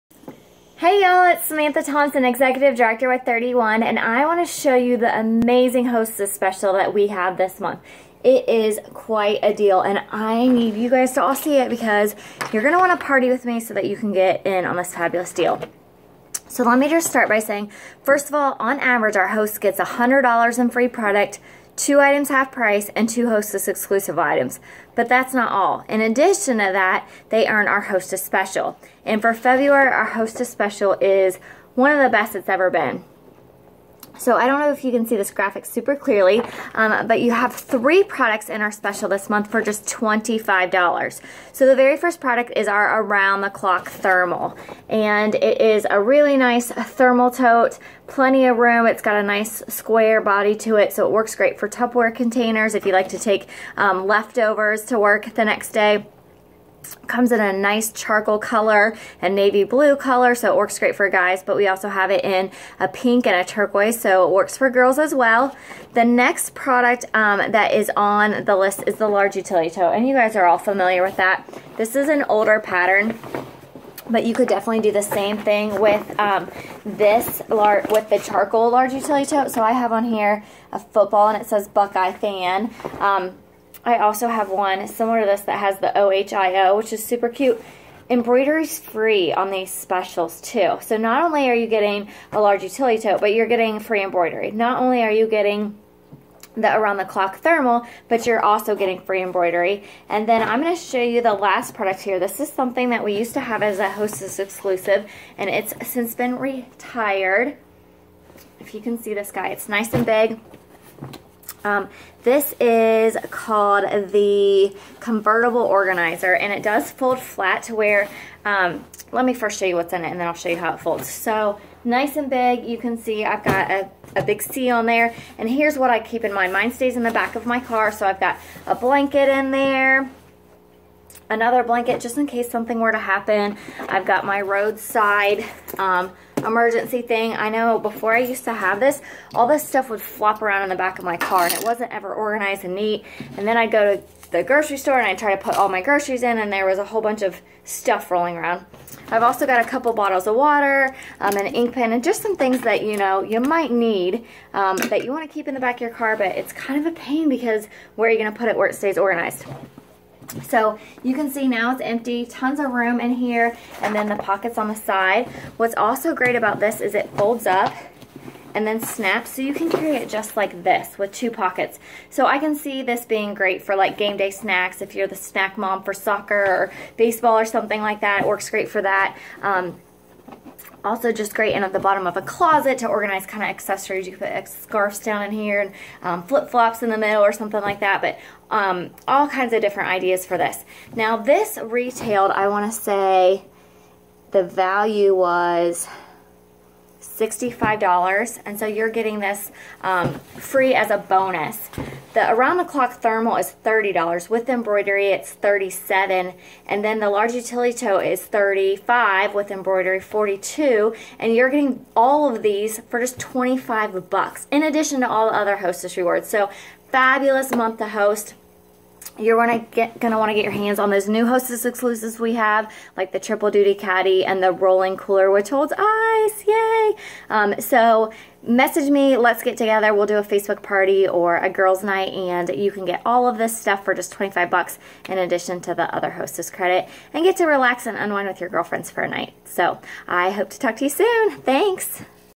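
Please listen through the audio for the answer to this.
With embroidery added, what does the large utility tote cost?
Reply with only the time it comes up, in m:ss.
3:29.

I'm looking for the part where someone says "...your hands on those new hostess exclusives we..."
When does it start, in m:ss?
3:40.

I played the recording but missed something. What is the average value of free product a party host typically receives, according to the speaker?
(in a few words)
$100.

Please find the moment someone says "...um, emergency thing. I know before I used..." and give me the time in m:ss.
2:15.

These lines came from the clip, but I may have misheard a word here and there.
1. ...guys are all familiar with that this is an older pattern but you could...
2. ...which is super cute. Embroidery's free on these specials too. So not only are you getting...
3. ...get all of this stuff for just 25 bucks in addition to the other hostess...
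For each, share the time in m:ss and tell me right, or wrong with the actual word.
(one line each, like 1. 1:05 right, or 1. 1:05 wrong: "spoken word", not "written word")
1. 1:10 right
2. 1:26 right
3. 3:52 right.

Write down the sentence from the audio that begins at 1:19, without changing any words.
So I have on here a football and it says Buckeye fan.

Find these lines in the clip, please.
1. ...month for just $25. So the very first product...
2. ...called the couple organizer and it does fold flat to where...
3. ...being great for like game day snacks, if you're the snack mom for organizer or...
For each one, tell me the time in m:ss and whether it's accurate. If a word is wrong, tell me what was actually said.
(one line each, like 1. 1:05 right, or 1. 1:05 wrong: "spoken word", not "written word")
1. 0:39 right
2. 1:53 wrong: "convertible", not "couple"
3. 2:53 wrong: "soccer", not "organizer".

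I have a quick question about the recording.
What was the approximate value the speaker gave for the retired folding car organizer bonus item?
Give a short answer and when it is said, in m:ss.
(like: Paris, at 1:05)
$65, at 3:17.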